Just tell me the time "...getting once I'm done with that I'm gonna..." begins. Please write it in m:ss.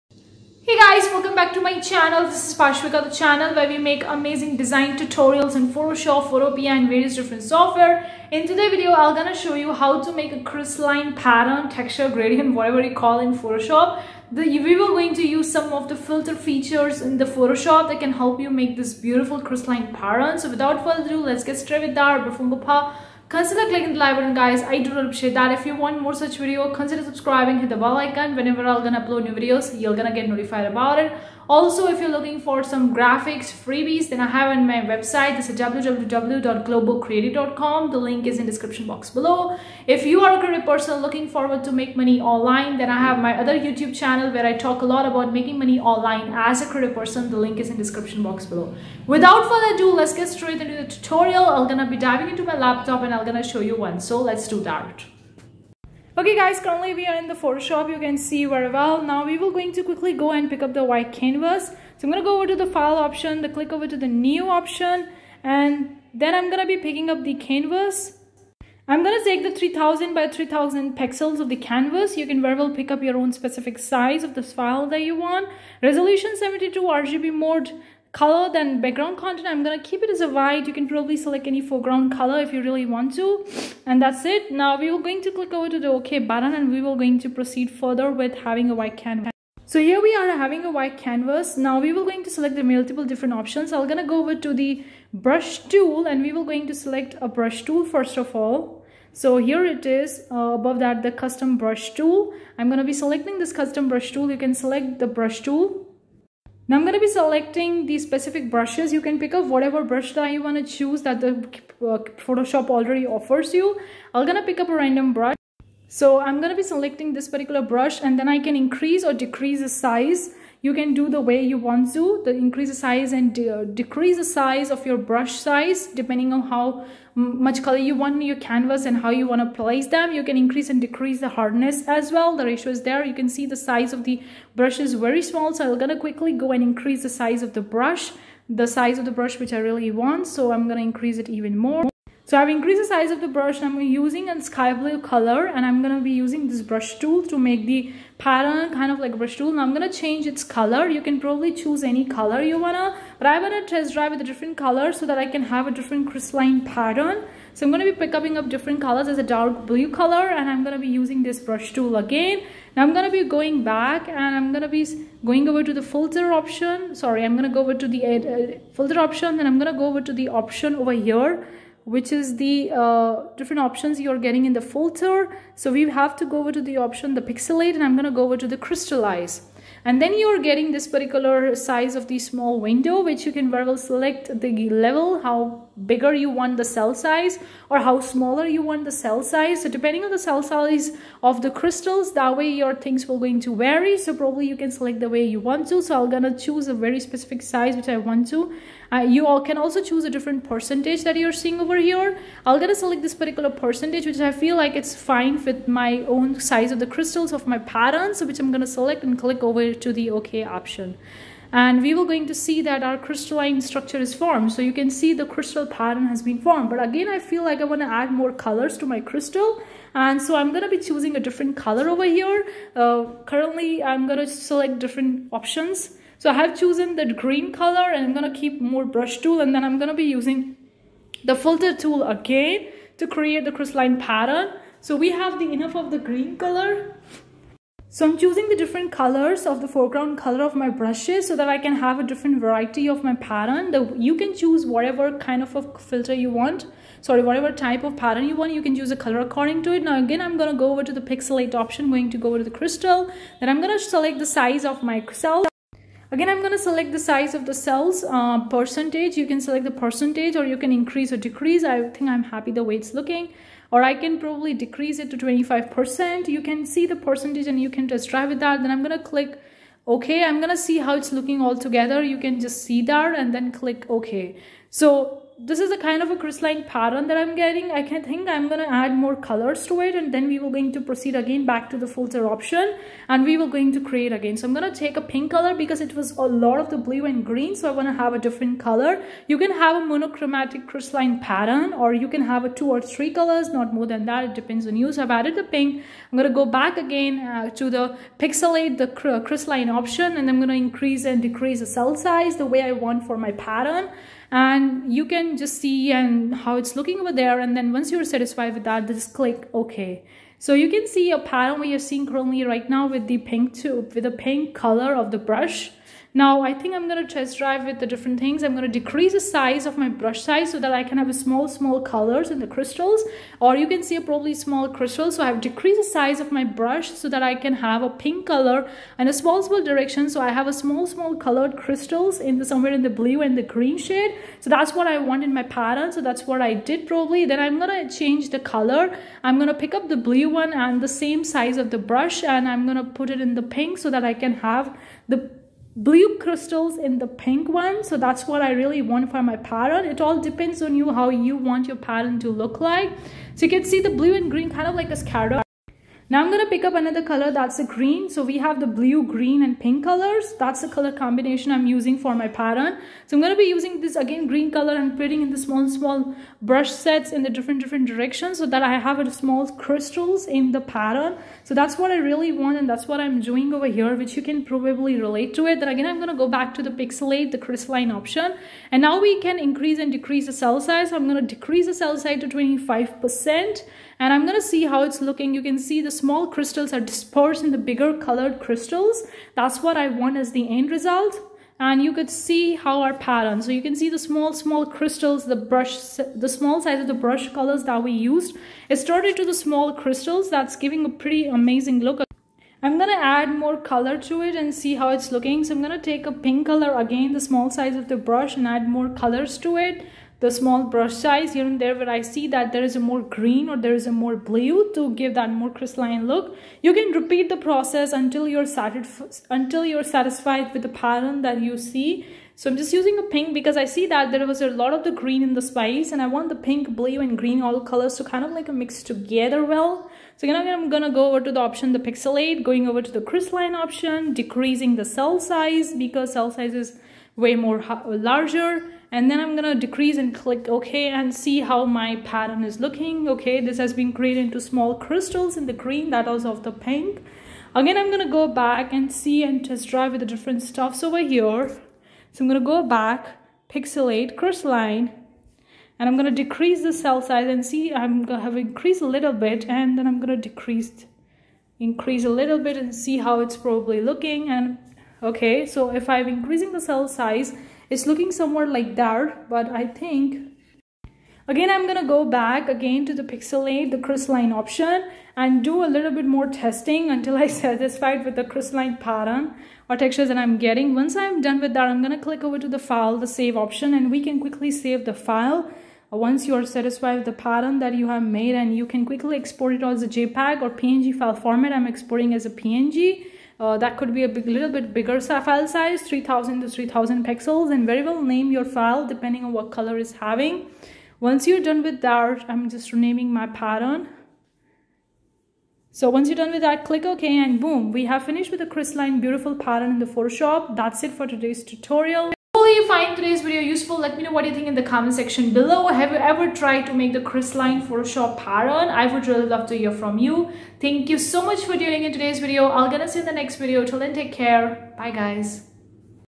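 8:00.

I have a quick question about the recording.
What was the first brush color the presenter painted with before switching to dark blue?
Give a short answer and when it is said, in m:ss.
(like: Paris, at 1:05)
Sky blue, at 2:24.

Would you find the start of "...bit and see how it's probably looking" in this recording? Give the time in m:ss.
7:42.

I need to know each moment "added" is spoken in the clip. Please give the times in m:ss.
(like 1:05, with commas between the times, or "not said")
4:55.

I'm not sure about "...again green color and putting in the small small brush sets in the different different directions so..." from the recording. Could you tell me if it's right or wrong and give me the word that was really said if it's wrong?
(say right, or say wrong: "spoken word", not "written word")
right.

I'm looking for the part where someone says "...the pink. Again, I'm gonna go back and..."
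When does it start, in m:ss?
7:26.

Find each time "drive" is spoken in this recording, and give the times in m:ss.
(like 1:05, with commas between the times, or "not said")
2:33, 5:17, 7:29.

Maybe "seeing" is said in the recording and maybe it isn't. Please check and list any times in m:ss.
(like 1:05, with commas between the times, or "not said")
3:21, 5:11.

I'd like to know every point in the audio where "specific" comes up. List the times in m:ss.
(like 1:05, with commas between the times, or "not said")
1:13, 1:47, 3:16.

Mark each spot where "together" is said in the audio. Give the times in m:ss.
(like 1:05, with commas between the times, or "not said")
4:31, 7:08.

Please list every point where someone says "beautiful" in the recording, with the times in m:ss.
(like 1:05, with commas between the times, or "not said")
0:18, 8:28.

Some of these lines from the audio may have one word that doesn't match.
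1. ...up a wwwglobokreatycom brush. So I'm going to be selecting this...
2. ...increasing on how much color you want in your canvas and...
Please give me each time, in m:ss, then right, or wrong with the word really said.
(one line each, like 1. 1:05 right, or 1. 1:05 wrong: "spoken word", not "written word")
1. 1:54 wrong: "random", not "wwwglobokreatycom"
2. 2:05 wrong: "depending", not "increasing".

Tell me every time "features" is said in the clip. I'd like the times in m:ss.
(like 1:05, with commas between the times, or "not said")
0:16.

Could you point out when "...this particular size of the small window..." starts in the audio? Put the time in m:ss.
3:00.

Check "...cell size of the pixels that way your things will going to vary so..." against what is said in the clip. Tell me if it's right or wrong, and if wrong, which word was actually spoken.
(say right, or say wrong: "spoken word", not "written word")
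wrong: "crystals", not "pixels".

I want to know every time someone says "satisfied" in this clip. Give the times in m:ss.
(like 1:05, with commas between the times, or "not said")
5:08, 6:59, 7:57, 8:06.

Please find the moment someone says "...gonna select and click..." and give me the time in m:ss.
3:28.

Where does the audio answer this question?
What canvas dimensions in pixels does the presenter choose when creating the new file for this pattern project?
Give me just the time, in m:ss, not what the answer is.
1:09.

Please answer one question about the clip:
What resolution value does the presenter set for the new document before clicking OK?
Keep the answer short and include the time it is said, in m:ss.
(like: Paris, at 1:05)
72, at 1:15.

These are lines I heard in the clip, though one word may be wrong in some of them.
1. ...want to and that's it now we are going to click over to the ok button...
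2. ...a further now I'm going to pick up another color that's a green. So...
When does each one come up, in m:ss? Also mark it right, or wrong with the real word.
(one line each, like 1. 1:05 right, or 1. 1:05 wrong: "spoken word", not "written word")
1. 1:22 right
2. 5:54 wrong: "scatter", not "further".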